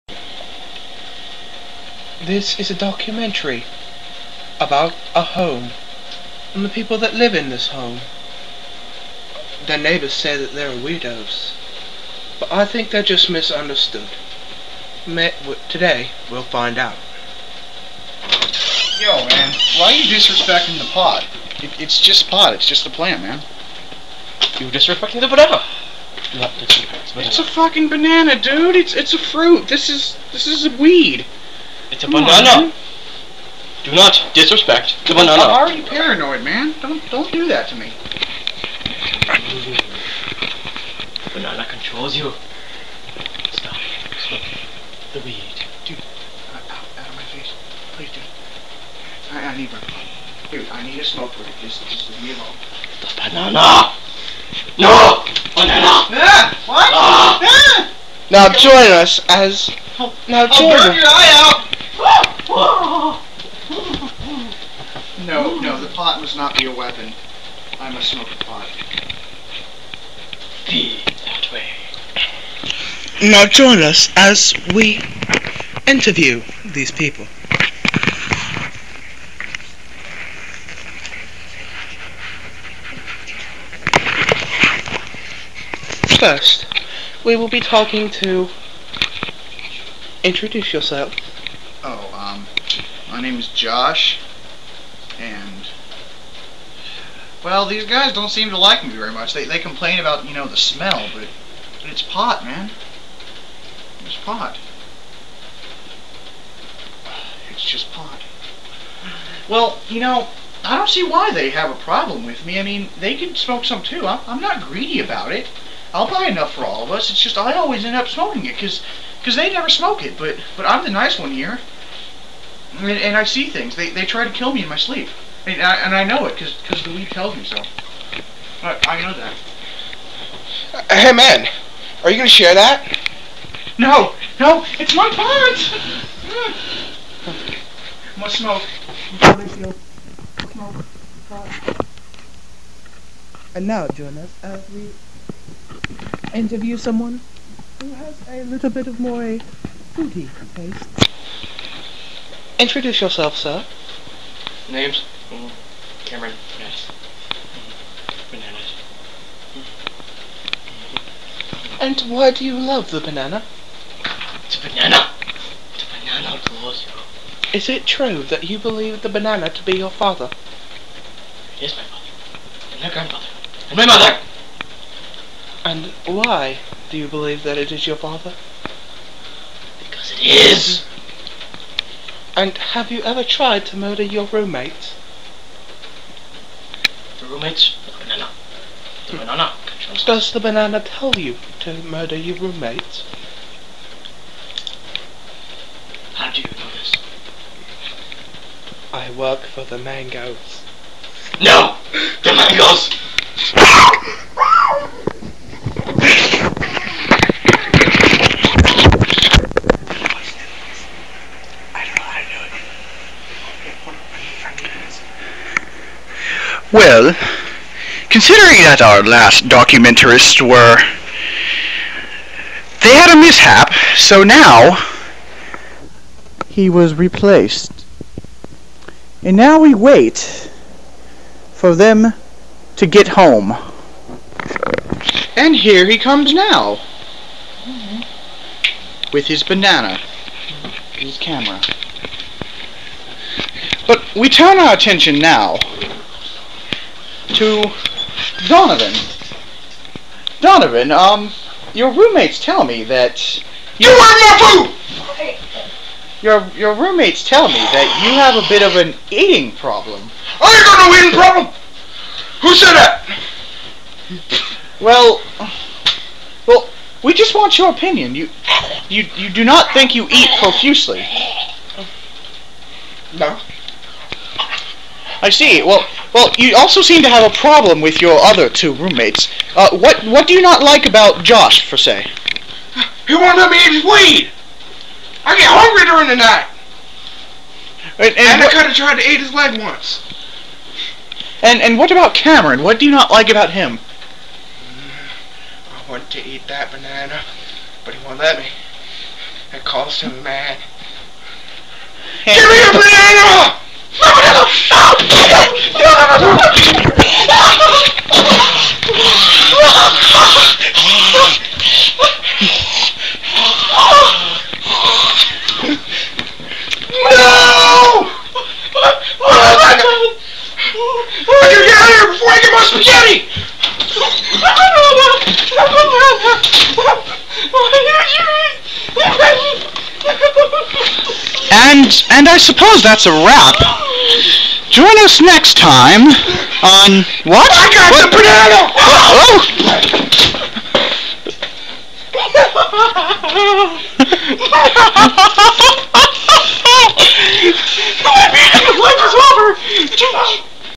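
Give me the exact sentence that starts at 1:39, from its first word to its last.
They, they complain about, you know, the smell, but, but it's pot, man.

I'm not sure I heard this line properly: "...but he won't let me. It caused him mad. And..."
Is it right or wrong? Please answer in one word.
right.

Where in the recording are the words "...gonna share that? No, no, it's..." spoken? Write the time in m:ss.
2:12.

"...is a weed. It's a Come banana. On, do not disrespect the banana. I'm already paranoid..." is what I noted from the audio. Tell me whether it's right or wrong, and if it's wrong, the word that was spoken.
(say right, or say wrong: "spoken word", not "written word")
right.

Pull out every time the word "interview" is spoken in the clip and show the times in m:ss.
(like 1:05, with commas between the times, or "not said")
1:15, 2:26.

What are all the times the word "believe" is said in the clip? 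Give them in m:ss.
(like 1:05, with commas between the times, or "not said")
2:48, 2:57.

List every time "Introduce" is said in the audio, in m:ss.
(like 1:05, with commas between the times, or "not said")
1:30, 2:32.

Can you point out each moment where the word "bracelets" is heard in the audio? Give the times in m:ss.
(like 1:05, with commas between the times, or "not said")
not said.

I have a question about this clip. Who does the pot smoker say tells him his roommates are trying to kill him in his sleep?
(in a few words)
Louis.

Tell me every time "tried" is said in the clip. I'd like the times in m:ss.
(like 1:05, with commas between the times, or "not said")
3:03, 4:48.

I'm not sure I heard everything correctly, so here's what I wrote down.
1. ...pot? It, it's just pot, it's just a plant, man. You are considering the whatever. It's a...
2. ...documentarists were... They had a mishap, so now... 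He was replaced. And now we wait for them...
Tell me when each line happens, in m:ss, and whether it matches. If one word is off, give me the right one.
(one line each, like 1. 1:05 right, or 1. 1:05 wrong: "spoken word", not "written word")
1. 0:20 wrong: "disrespecting", not "considering"
2. 3:39 right.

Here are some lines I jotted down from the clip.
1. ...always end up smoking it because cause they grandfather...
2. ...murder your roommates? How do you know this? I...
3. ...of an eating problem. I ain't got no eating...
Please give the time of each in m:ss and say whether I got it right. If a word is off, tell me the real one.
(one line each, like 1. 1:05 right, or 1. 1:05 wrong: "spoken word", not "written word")
1. 1:57 wrong: "never", not "grandfather"
2. 3:11 right
3. 4:18 right.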